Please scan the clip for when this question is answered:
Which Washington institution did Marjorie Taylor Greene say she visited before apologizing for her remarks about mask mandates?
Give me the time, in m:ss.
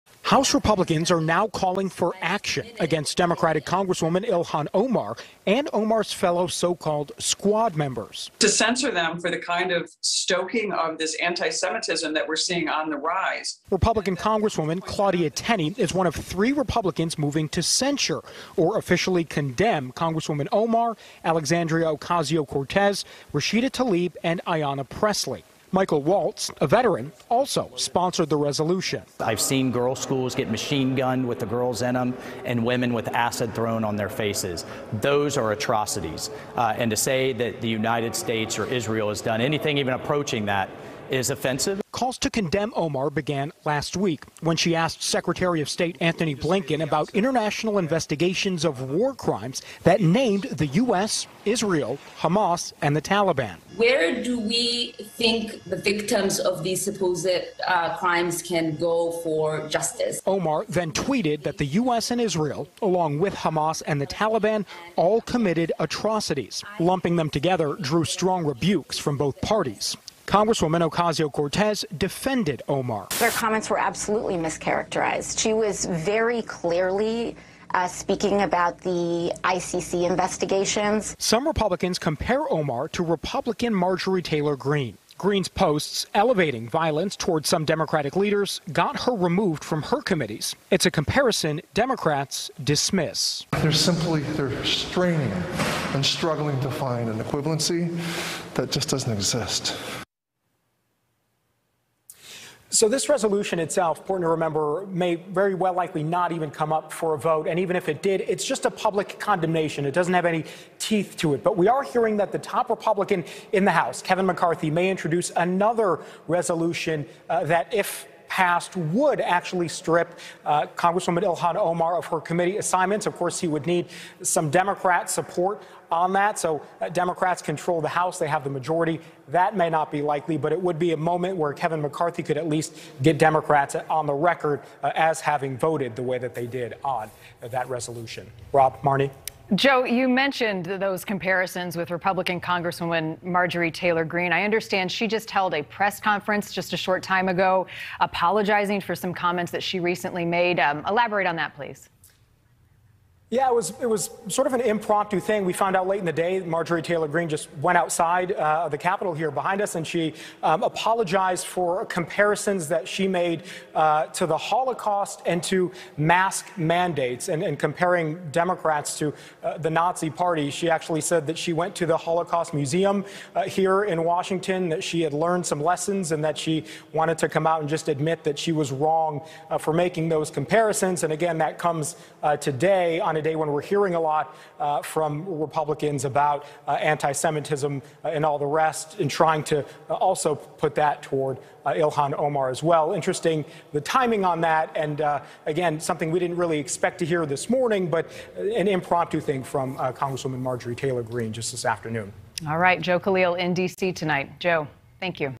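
2:51.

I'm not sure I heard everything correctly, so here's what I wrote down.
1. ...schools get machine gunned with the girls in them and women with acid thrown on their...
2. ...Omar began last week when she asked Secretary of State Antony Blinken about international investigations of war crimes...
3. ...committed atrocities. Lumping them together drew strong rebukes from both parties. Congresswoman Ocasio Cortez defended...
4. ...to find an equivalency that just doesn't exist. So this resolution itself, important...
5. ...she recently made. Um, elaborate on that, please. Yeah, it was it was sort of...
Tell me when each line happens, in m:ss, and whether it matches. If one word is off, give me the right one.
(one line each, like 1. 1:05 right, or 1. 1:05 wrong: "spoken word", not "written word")
1. 0:30 right
2. 0:42 right
3. 1:05 right
4. 1:36 right
5. 2:29 right.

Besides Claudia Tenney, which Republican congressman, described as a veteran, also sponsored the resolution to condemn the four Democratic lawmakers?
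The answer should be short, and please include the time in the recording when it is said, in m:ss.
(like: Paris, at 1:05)
Michael Waltz, at 0:25.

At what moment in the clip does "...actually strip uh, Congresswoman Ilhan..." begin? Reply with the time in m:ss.
1:59.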